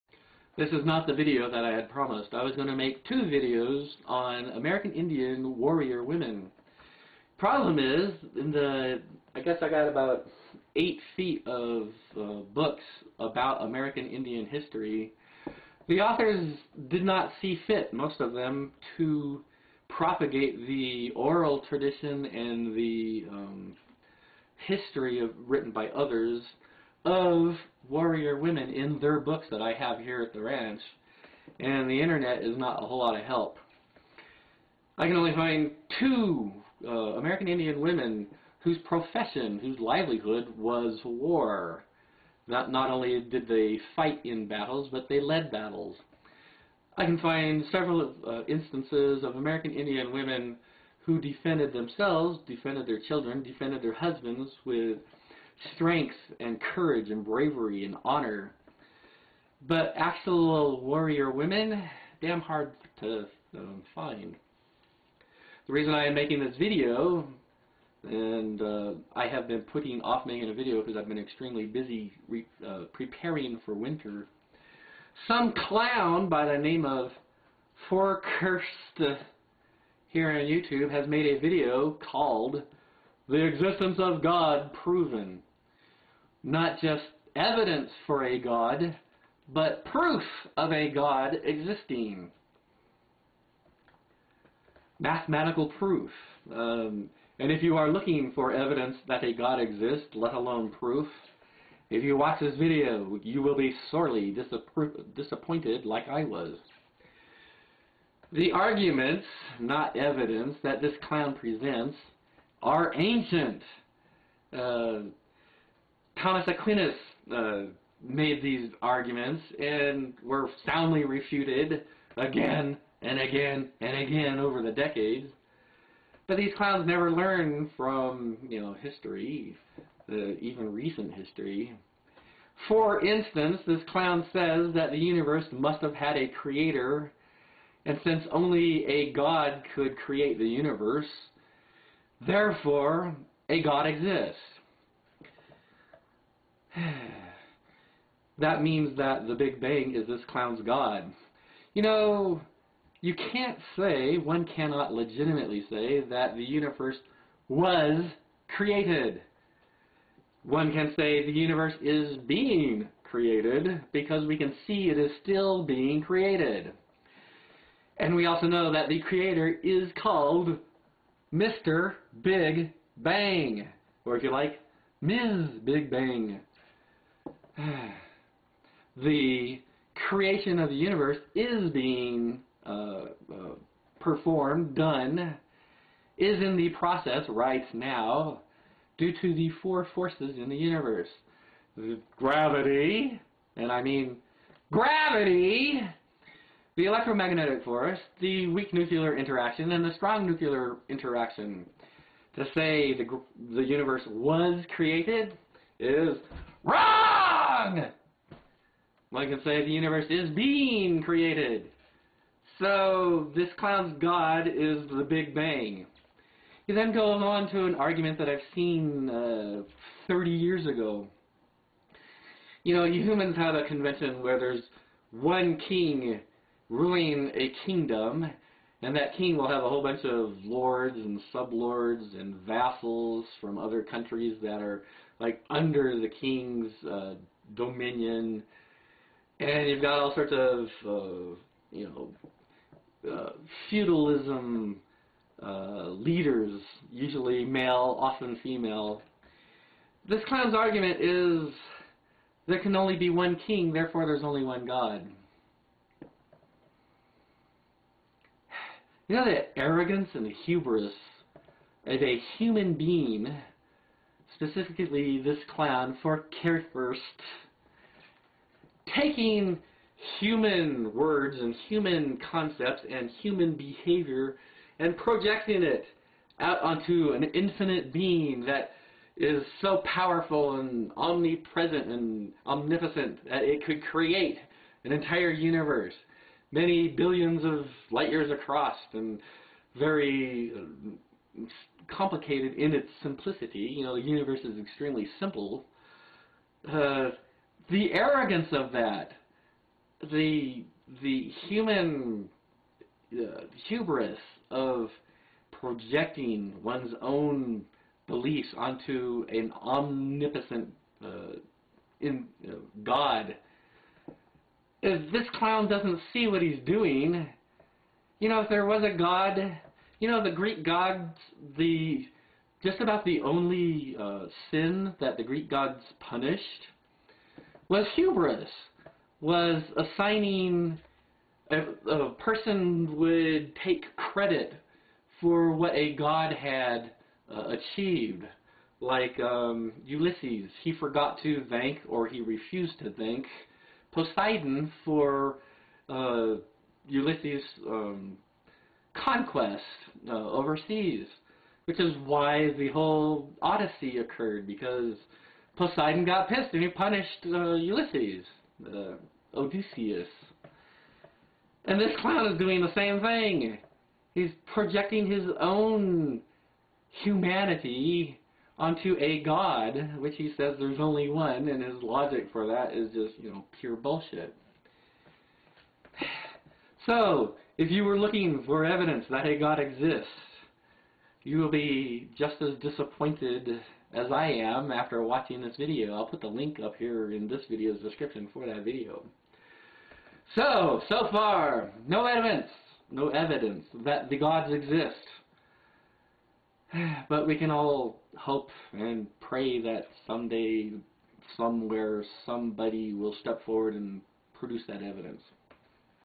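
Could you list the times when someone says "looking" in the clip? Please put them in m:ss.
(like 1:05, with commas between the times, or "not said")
1:37, 6:17.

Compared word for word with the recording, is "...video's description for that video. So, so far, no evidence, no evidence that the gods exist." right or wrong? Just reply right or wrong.
right.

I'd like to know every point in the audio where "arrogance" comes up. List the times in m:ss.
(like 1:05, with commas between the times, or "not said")
4:19, 4:57.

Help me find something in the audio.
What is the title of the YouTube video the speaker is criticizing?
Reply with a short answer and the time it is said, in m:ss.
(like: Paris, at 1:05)
The Existence of God Proven, at 1:23.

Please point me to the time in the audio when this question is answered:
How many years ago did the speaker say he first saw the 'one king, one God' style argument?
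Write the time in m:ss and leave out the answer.
3:40.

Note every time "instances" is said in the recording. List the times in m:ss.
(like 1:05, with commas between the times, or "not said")
0:48, 2:13.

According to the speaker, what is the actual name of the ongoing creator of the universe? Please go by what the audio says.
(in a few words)
Mr. Big Bang.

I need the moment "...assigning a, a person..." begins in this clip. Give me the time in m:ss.
5:29.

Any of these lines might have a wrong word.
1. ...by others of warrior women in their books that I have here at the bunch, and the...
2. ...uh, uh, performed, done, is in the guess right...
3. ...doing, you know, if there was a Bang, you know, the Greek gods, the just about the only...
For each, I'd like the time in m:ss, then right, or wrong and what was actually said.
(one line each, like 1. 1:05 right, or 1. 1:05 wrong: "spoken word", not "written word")
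1. 0:25 wrong: "ranch", not "bunch"
2. 3:02 wrong: "process", not "guess"
3. 5:16 wrong: "God", not "Bang".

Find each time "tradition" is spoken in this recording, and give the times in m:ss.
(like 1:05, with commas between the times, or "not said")
0:21.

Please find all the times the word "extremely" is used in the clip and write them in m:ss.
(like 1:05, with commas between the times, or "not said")
1:11, 4:54.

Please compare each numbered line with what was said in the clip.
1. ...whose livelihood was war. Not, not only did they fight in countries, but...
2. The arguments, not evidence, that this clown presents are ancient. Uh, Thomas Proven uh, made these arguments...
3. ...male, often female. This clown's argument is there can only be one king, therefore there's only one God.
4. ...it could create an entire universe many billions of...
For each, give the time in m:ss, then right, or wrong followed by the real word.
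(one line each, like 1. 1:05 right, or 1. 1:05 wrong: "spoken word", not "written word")
1. 0:39 wrong: "battles", not "countries"
2. 1:48 wrong: "Aquinas", not "Proven"
3. 4:07 right
4. 4:43 right.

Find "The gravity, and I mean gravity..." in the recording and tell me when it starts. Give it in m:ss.
3:11.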